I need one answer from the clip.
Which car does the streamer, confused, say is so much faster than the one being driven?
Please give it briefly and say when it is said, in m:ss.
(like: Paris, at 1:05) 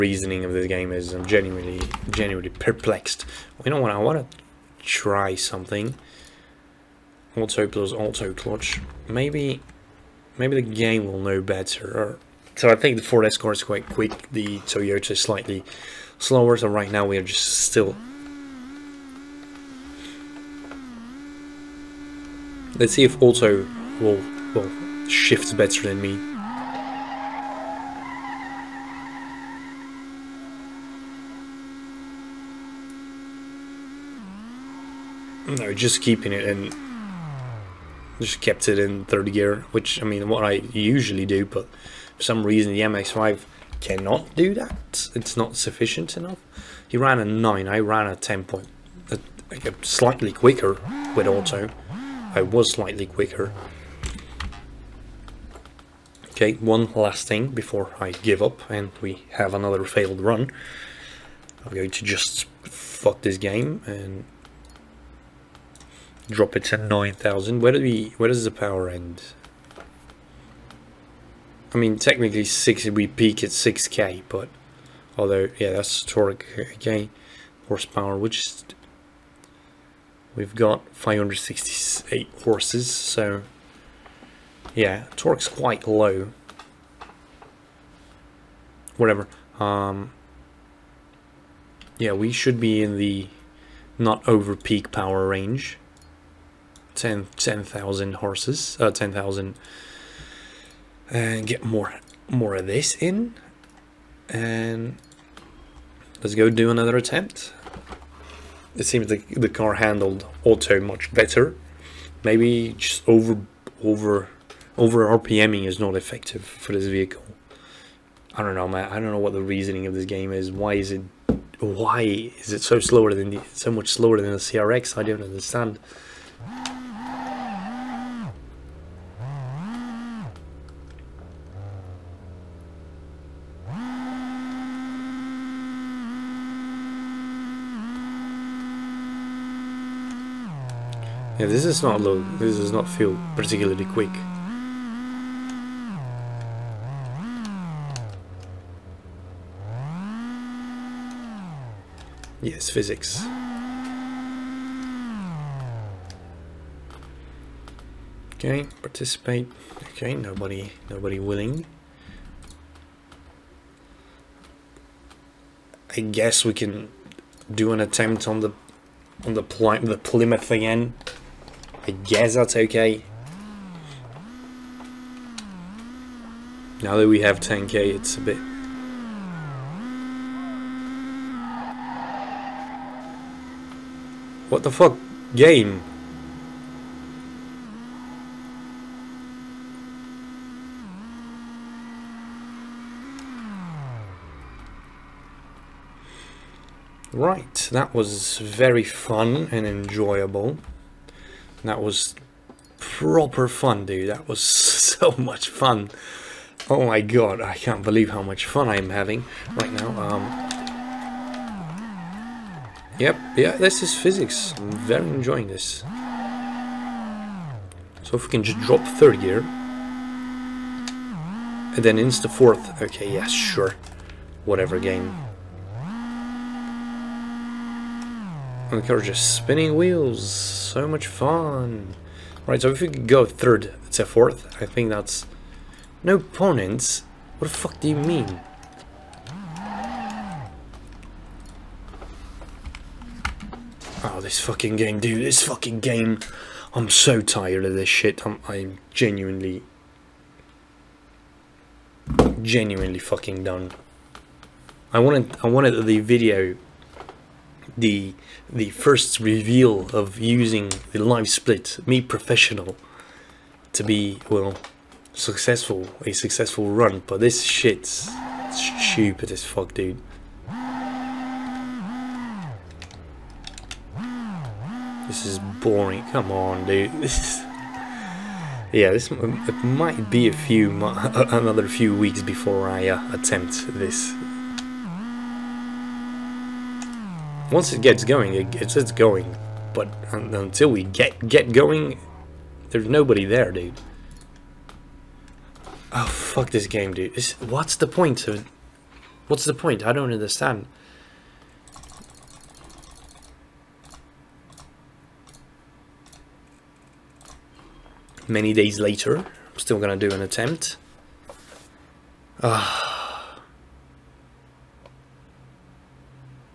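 CRX, at 2:04.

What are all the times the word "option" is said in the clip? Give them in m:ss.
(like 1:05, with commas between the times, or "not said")
not said.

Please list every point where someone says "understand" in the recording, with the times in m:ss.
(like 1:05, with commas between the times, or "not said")
2:05, 5:00.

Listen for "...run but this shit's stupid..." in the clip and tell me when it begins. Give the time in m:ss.
4:26.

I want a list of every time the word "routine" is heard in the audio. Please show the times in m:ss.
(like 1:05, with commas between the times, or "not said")
not said.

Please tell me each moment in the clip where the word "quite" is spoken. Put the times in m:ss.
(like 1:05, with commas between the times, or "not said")
0:13, 1:25.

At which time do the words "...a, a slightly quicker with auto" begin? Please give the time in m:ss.
0:49.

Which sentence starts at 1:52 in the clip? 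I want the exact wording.
Maybe just over over over RPMing is not effective for this vehicle.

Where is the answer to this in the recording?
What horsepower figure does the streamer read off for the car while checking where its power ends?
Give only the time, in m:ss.
1:20.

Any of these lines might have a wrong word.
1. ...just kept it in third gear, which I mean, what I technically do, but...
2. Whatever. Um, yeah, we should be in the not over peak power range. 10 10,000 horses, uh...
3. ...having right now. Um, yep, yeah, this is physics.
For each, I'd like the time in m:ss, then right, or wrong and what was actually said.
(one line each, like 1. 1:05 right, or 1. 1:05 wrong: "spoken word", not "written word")
1. 0:38 wrong: "usually", not "technically"
2. 1:28 right
3. 3:28 right.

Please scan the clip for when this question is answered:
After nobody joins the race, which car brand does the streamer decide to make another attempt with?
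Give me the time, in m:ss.
2:49.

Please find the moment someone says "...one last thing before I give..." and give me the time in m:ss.
0:56.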